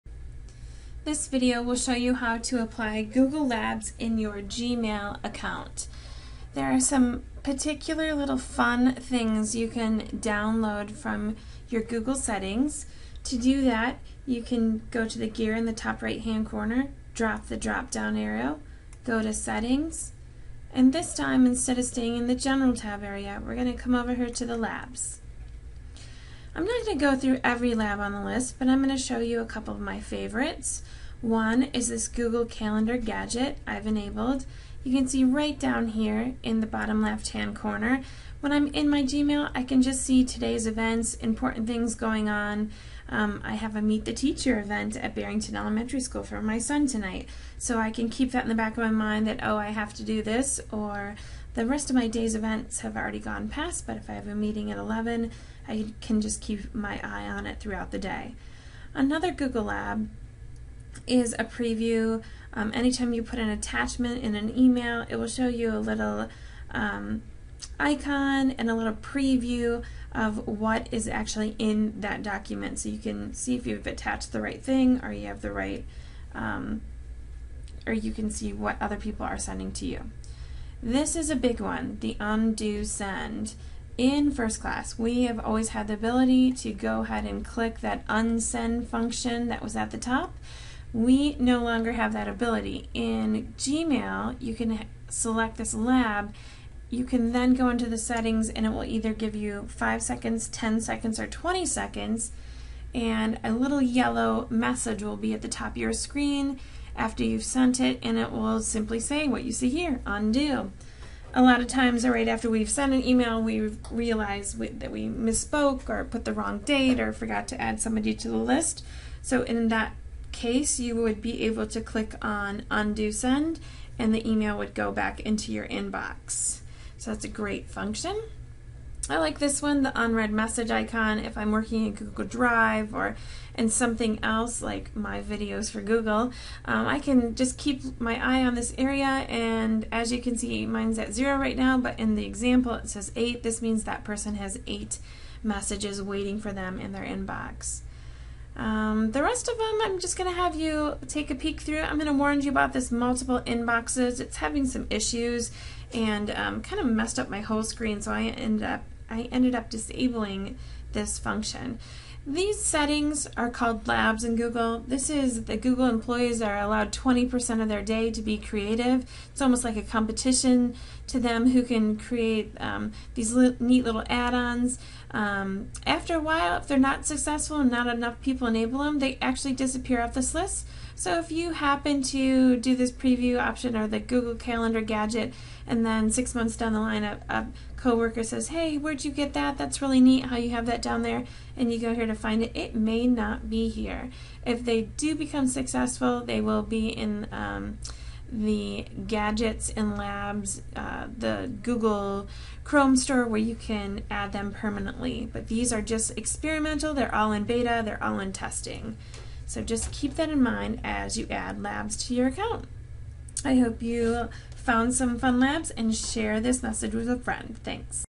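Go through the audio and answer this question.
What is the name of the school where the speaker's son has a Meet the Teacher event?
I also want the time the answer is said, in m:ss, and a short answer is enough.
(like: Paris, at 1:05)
Barrington Elementary School, at 0:45.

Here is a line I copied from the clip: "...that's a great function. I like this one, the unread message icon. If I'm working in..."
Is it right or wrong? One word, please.
right.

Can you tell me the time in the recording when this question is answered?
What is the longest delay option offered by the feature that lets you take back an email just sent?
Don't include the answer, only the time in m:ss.
1:41.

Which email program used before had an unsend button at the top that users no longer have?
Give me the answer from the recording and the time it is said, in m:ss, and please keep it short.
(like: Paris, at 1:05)
FirstClass, at 1:24.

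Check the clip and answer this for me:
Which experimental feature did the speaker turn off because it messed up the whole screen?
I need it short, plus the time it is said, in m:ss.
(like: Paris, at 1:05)
Multiple inboxes, at 2:32.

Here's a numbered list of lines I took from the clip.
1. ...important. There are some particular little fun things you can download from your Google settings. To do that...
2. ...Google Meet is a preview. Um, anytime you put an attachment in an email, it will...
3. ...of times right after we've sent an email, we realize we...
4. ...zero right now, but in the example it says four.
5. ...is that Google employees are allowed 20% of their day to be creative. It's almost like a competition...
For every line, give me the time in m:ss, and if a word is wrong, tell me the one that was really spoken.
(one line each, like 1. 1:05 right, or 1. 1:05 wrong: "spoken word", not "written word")
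1. 0:05 wrong: "account", not "important"
2. 0:59 wrong: "Lab", not "Meet"
3. 1:51 right
4. 2:21 wrong: "eight", not "four"
5. 2:45 right.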